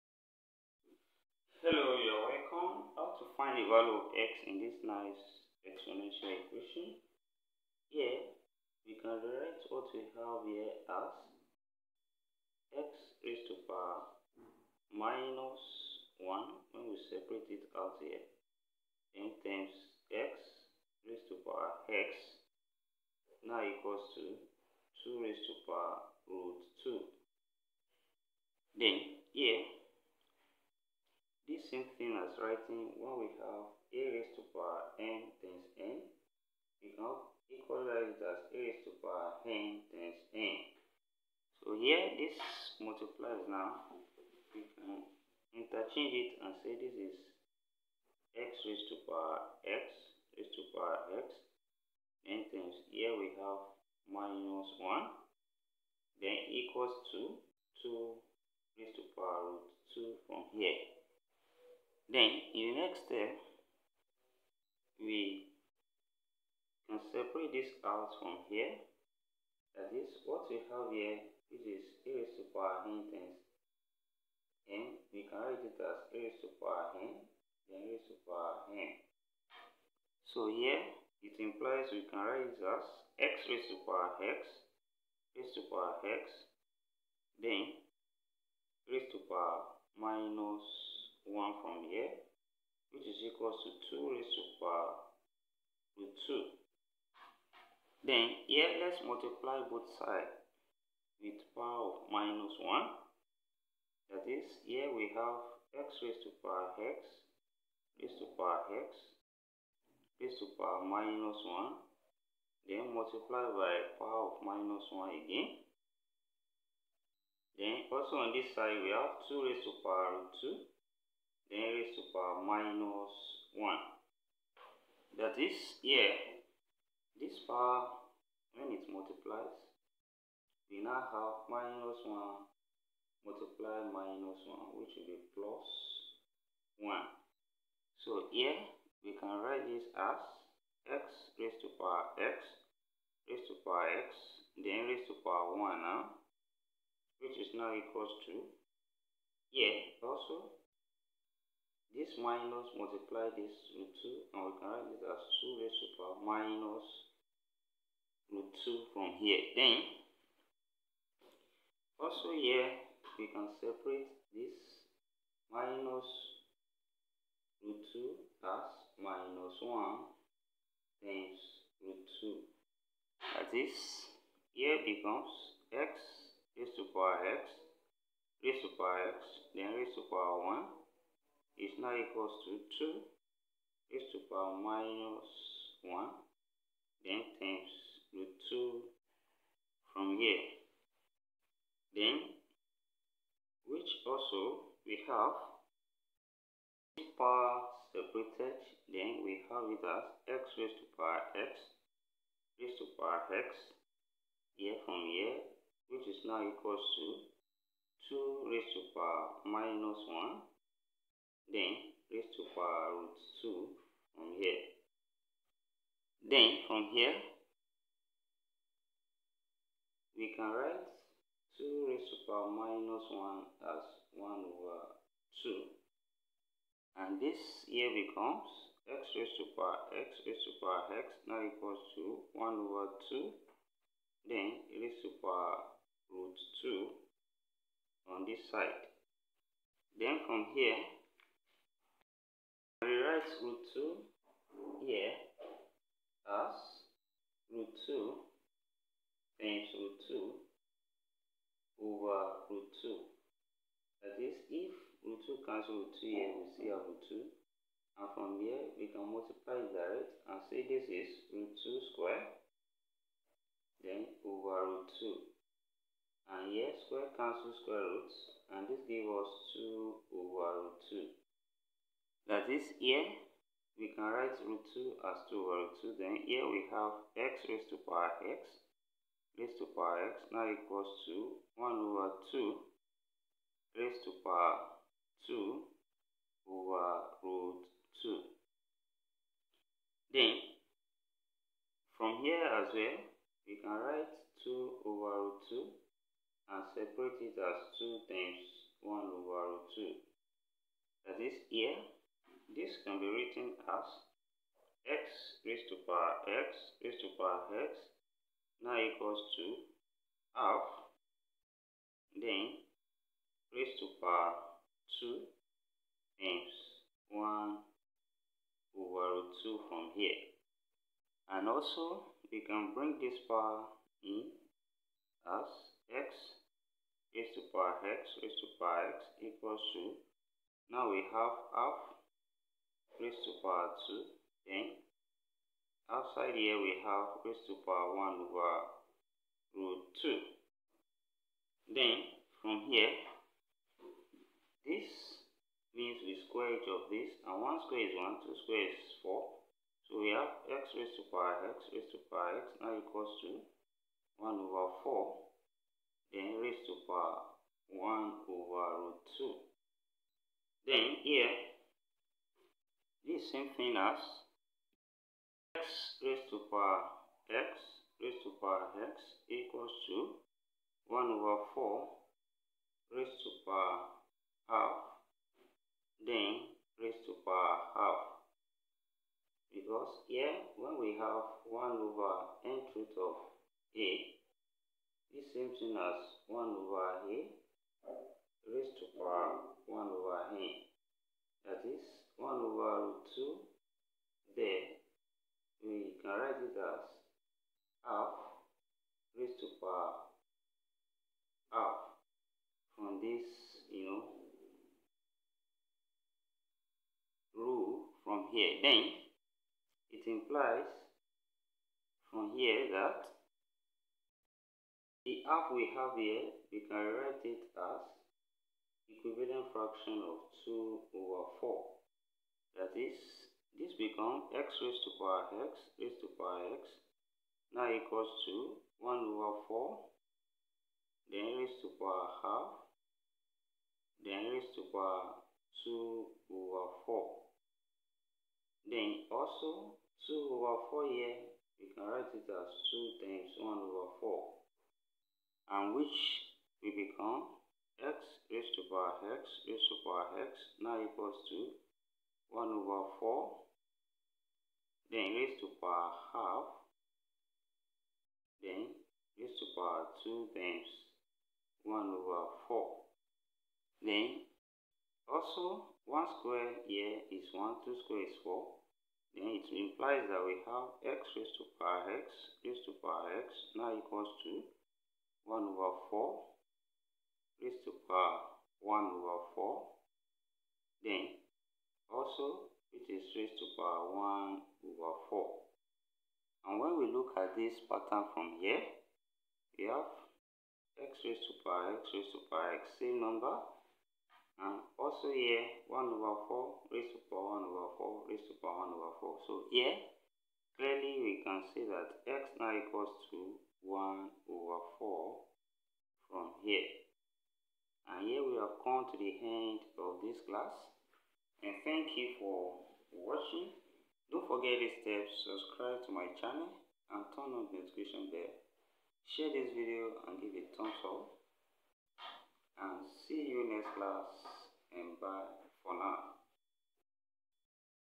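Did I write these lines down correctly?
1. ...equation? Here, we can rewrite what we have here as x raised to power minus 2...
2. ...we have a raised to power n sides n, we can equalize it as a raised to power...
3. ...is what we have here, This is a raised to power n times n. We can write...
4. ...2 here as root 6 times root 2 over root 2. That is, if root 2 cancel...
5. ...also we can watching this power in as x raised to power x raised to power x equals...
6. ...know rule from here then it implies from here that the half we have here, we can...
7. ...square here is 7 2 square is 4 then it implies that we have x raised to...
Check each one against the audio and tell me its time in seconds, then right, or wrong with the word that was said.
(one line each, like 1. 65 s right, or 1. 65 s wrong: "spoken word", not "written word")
1. 6 s wrong: "1", not "2"
2. 33 s wrong: "times", not "sides"
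3. 69 s right
4. 243 s wrong: "2", not "6"
5. 321 s wrong: "bring", not "watching"
6. 403 s right
7. 466 s wrong: "1", not "7".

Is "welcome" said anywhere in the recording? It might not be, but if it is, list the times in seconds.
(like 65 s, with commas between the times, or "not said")
2 s.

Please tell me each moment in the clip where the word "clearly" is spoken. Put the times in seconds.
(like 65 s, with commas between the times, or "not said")
500 s.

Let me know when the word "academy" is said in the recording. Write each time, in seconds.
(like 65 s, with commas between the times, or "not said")
not said.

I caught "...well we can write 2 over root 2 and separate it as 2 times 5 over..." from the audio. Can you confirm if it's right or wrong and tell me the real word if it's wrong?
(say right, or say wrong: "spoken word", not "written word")
wrong: "1", not "5".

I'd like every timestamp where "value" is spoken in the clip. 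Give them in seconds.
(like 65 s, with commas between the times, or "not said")
3 s.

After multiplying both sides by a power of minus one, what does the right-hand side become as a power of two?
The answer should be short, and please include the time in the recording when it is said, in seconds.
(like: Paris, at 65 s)
2^(-√2), at 155 s.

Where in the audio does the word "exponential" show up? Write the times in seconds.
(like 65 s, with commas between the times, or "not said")
5 s.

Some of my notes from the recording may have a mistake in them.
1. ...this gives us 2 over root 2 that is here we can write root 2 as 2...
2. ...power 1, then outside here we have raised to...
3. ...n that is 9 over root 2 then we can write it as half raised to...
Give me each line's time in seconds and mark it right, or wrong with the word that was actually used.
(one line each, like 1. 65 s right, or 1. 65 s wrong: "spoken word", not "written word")
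1. 268 s right
2. 333 s wrong: "2", not "1"
3. 390 s wrong: "1", not "9".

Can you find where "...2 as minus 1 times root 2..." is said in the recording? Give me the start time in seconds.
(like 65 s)
167 s.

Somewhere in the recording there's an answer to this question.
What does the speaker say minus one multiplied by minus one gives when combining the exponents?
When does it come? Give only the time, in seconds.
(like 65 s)
135 s.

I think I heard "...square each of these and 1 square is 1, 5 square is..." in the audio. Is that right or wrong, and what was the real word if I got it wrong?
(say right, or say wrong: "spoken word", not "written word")
wrong: "2", not "5".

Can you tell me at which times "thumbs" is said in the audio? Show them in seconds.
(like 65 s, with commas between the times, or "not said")
520 s.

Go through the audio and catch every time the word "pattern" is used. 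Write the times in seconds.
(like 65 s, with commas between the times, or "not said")
487 s.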